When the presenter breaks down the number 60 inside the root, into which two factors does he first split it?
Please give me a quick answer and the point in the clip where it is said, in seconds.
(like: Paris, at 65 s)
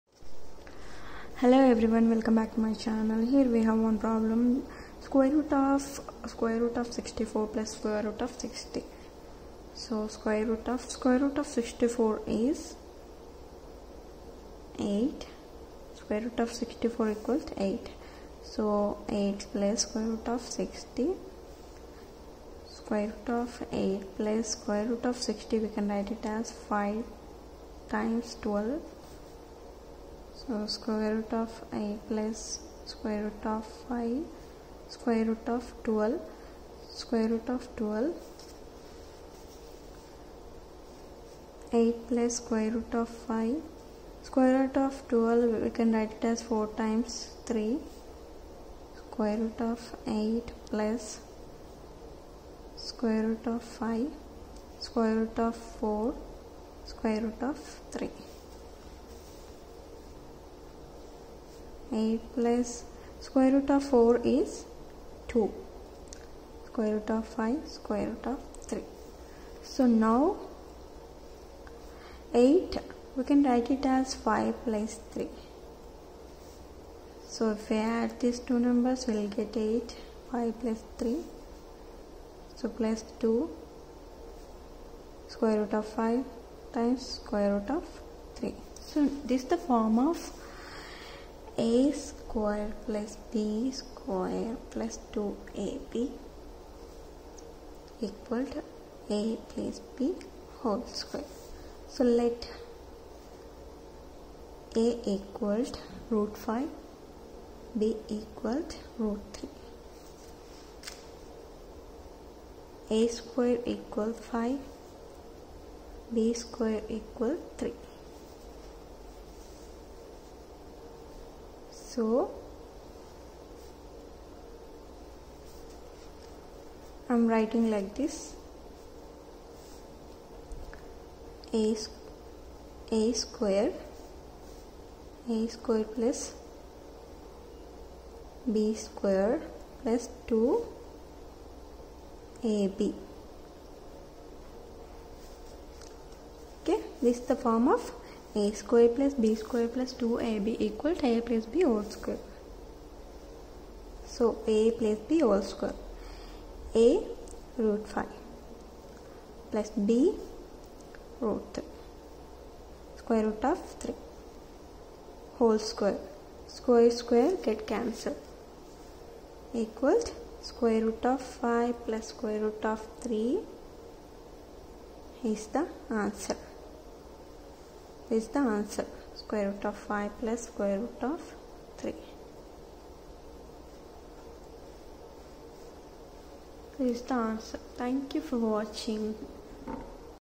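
5 times 12, at 26 s.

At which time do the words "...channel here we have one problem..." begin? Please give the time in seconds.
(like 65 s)
2 s.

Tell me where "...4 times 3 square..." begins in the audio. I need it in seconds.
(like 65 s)
46 s.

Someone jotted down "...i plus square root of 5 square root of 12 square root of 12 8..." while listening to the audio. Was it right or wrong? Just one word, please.
right.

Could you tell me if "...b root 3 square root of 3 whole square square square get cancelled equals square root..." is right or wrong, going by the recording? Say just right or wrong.
right.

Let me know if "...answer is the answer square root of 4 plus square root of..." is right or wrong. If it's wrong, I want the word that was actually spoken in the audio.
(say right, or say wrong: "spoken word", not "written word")
wrong: "5", not "4".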